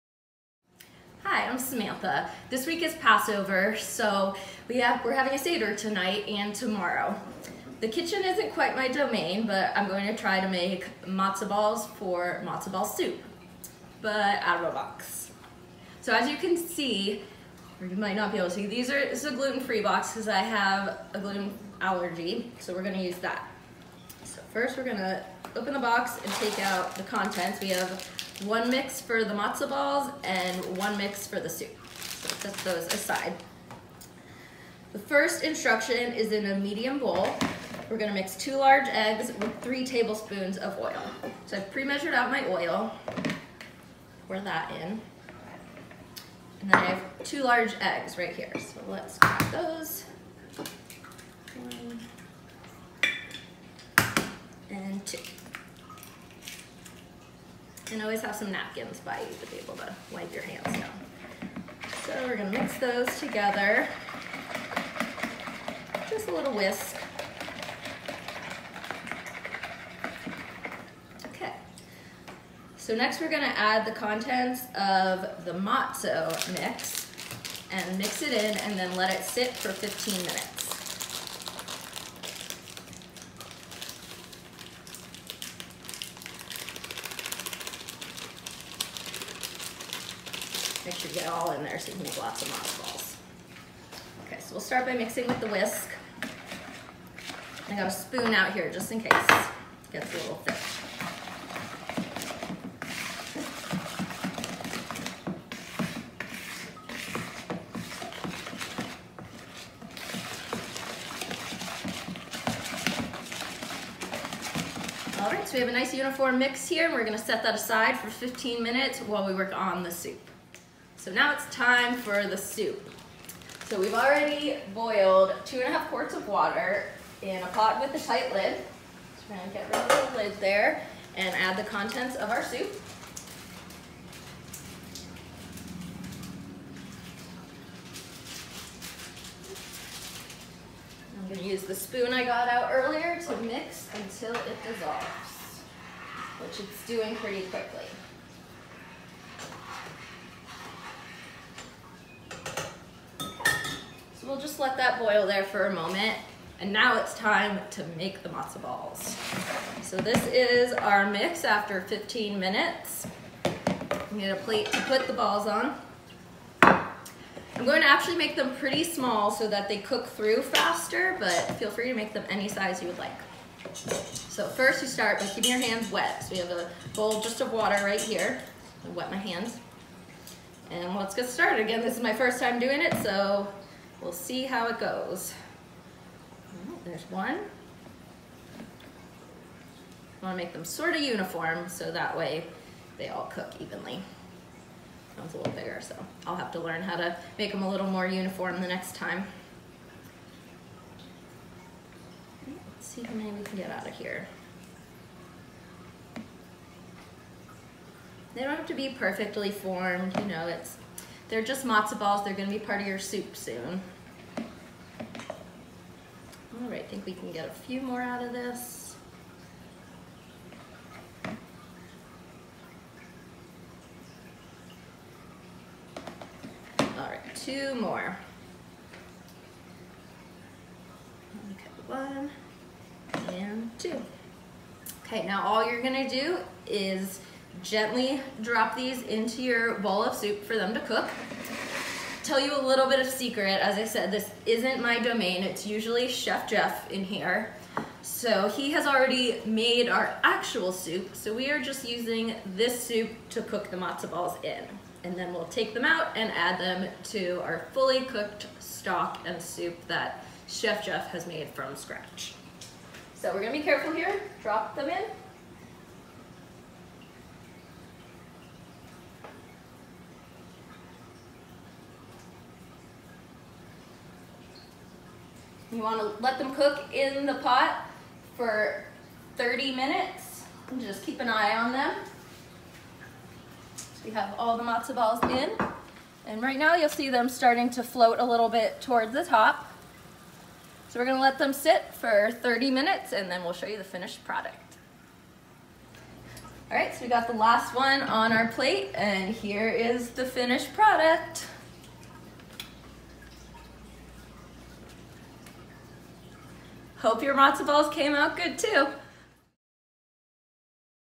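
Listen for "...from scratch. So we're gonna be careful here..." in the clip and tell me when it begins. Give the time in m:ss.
4:21.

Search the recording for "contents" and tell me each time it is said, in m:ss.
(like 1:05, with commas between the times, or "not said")
0:27, 1:13, 2:11.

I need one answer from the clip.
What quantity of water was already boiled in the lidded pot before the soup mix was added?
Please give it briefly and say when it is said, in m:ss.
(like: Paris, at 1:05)
2.5 quarts, at 2:05.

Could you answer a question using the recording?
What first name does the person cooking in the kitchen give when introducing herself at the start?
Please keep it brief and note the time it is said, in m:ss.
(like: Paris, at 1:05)
Samantha, at 0:01.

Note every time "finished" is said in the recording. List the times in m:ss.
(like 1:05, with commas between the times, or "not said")
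4:53, 5:00.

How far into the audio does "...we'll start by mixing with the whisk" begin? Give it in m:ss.
1:34.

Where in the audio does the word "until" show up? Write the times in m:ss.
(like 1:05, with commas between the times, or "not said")
2:23.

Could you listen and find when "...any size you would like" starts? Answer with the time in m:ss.
2:52.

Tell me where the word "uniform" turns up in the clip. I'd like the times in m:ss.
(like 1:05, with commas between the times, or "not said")
1:55, 3:11, 3:18.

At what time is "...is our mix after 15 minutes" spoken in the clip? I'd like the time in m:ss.
2:40.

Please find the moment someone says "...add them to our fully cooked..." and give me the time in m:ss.
4:16.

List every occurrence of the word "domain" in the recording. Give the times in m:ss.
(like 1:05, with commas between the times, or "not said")
0:08, 4:04.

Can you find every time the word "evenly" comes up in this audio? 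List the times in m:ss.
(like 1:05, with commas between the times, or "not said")
3:13.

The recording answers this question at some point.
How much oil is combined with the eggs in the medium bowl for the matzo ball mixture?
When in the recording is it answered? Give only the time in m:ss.
0:39.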